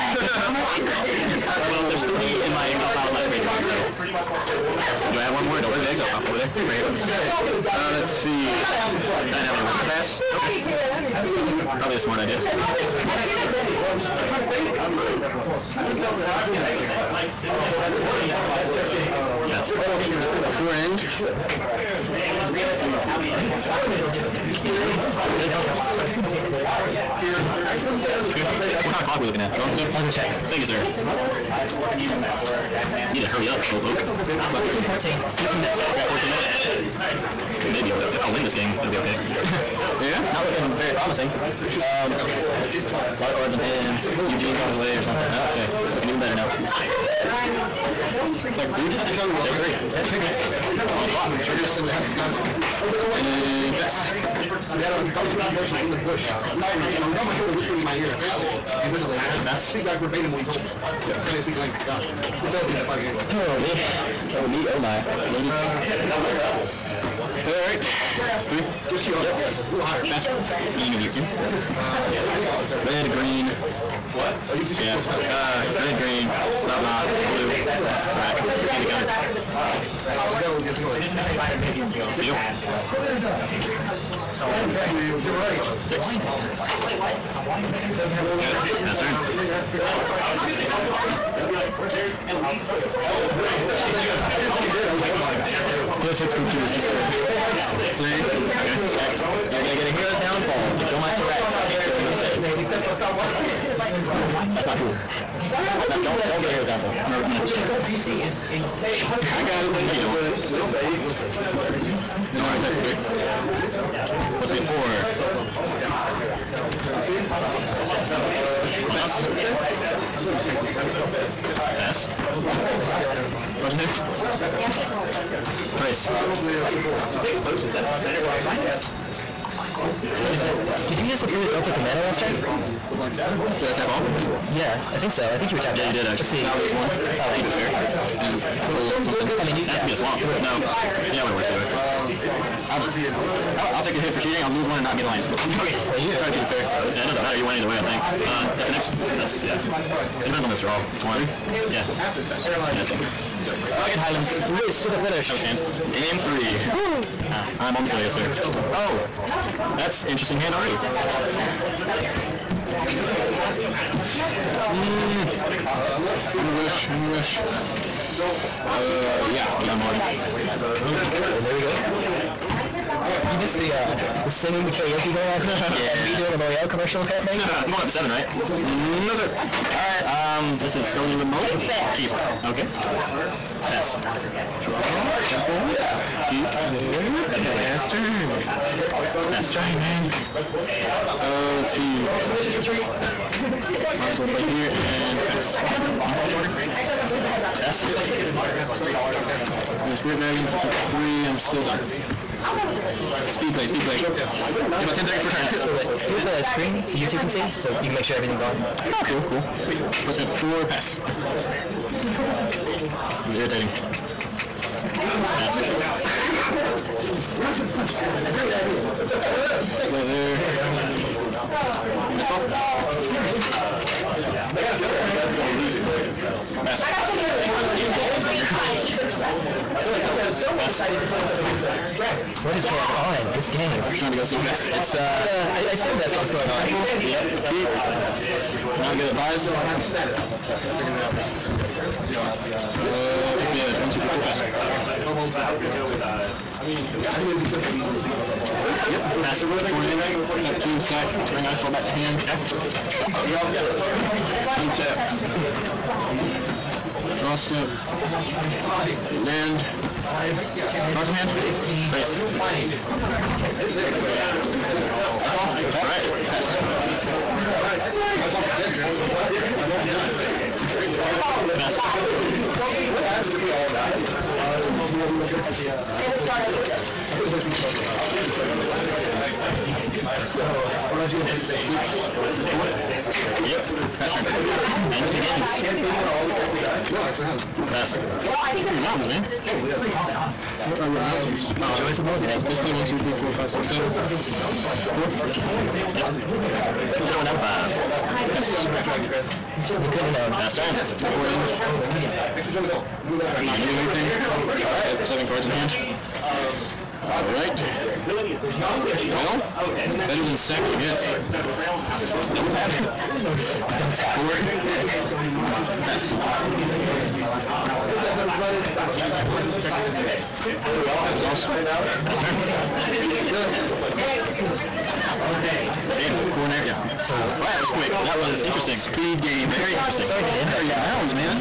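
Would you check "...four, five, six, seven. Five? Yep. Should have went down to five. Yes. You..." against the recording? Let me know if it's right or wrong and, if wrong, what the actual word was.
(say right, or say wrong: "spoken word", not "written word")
wrong: "Four", not "Five".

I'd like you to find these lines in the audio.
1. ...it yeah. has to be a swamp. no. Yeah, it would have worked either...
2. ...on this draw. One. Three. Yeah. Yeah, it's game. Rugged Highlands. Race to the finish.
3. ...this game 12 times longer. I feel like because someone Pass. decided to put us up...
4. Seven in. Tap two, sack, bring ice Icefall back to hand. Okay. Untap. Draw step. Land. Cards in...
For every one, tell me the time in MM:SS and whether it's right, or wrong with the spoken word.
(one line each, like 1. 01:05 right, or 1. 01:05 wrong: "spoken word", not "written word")
1. 02:19 right
2. 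02:30 right
3. 03:47 right
4. 04:09 wrong: "Four", not "Seven".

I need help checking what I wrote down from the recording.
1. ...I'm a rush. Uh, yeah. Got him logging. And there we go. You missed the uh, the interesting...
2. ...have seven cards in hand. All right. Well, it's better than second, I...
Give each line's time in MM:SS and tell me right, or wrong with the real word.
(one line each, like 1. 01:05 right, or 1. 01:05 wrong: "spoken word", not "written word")
1. 02:46 wrong: "singing", not "interesting"
2. 05:04 right.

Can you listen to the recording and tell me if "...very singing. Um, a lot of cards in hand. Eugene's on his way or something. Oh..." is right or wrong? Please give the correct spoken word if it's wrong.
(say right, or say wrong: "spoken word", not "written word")
wrong: "promising", not "singing".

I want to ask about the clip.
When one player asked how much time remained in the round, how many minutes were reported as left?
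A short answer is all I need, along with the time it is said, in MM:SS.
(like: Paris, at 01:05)
14, at 00:35.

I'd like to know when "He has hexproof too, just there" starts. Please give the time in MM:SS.
01:36.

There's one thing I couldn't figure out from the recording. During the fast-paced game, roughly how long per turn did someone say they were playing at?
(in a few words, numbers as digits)
10 seconds.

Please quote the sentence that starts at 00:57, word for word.
He was on my shoulder whispering in my ear, apparently, invisibly.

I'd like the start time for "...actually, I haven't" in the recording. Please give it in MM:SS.
04:47.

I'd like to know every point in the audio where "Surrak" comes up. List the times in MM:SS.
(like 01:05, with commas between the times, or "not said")
01:17, 01:41.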